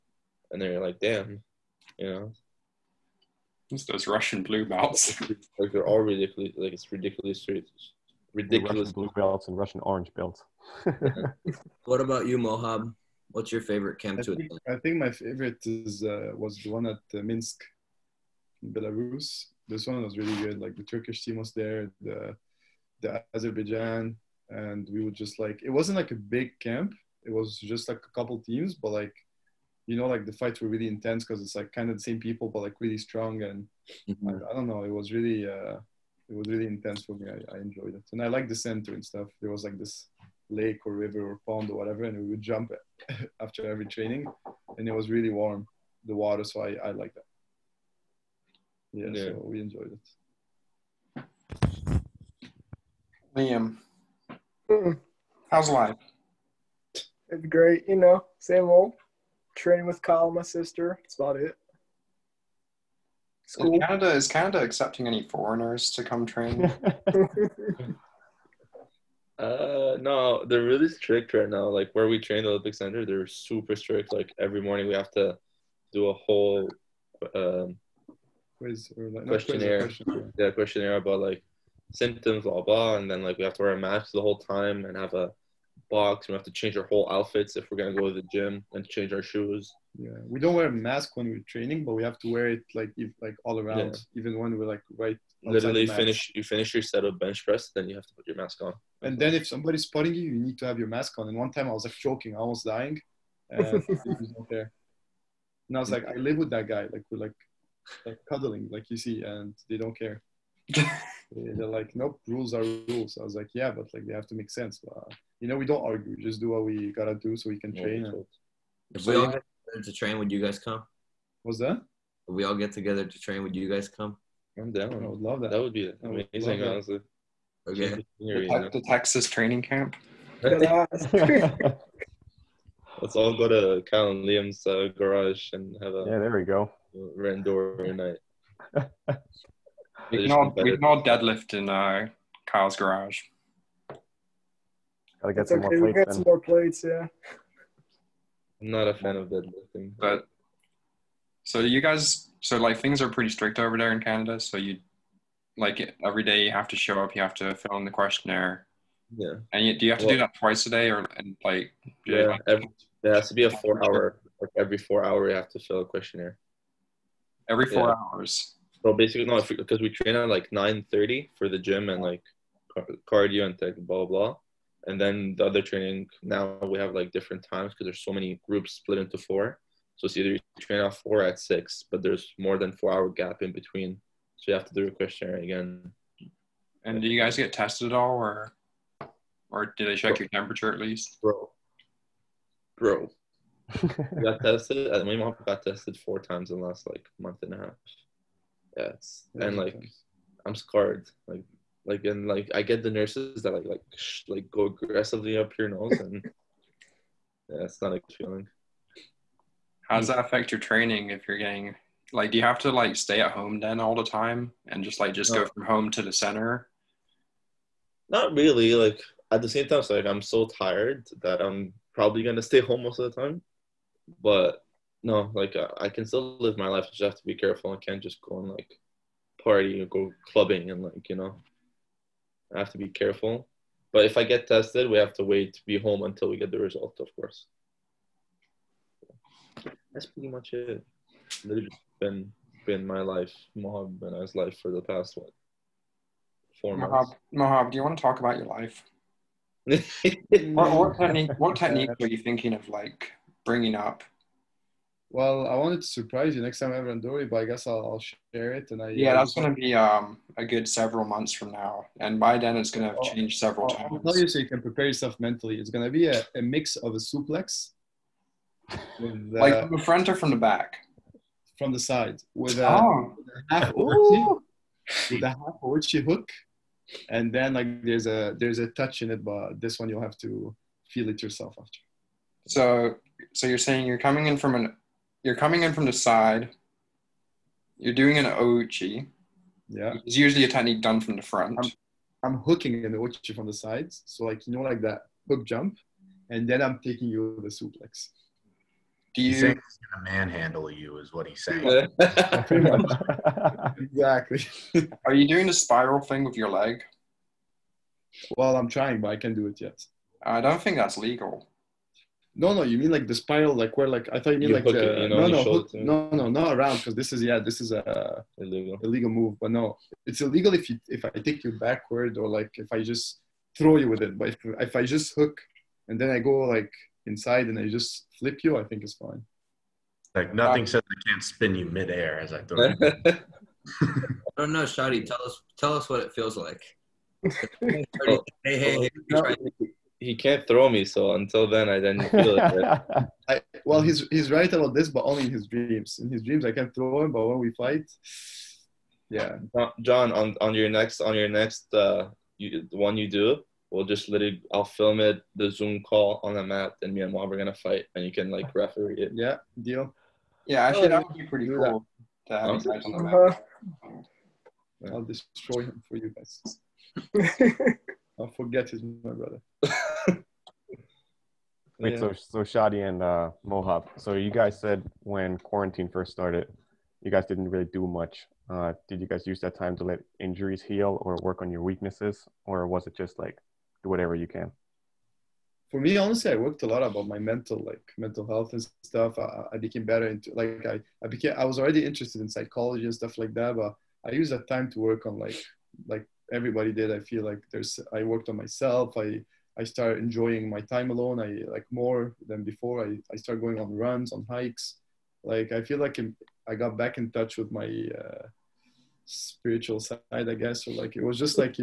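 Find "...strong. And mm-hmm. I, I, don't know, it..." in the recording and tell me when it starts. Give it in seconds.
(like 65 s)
32 s.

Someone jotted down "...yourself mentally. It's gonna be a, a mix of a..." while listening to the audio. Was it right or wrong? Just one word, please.
right.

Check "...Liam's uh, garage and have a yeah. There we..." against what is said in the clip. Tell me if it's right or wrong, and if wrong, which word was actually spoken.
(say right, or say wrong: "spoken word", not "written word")
right.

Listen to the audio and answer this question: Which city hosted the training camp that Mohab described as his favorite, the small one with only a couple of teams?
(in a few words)
Minsk.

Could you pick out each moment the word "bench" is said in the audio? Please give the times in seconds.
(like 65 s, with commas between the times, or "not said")
97 s.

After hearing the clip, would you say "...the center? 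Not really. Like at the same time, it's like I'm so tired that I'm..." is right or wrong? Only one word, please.
right.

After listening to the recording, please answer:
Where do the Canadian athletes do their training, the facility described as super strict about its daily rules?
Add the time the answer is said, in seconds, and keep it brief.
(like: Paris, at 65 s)
the Olympic Center, at 72 s.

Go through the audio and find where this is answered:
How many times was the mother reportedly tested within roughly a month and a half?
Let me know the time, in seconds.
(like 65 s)
195 s.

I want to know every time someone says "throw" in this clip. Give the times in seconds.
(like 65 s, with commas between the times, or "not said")
323 s, 332 s, 340 s, 346 s.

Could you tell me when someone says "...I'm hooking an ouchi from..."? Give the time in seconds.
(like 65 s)
292 s.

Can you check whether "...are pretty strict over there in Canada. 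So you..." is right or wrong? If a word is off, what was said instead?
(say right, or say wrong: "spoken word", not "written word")
right.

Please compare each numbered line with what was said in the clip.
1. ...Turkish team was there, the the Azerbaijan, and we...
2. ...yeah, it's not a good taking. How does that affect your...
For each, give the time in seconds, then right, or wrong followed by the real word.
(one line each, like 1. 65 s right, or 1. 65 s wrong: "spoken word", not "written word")
1. 20 s right
2. 207 s wrong: "feeling", not "taking".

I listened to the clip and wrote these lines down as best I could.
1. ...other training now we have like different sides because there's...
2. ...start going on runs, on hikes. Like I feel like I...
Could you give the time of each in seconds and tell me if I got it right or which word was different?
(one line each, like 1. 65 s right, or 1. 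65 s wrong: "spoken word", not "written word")
1. 175 s wrong: "times", not "sides"
2. 403 s right.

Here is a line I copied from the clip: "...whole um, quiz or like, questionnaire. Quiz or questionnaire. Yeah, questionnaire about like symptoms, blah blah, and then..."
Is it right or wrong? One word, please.
right.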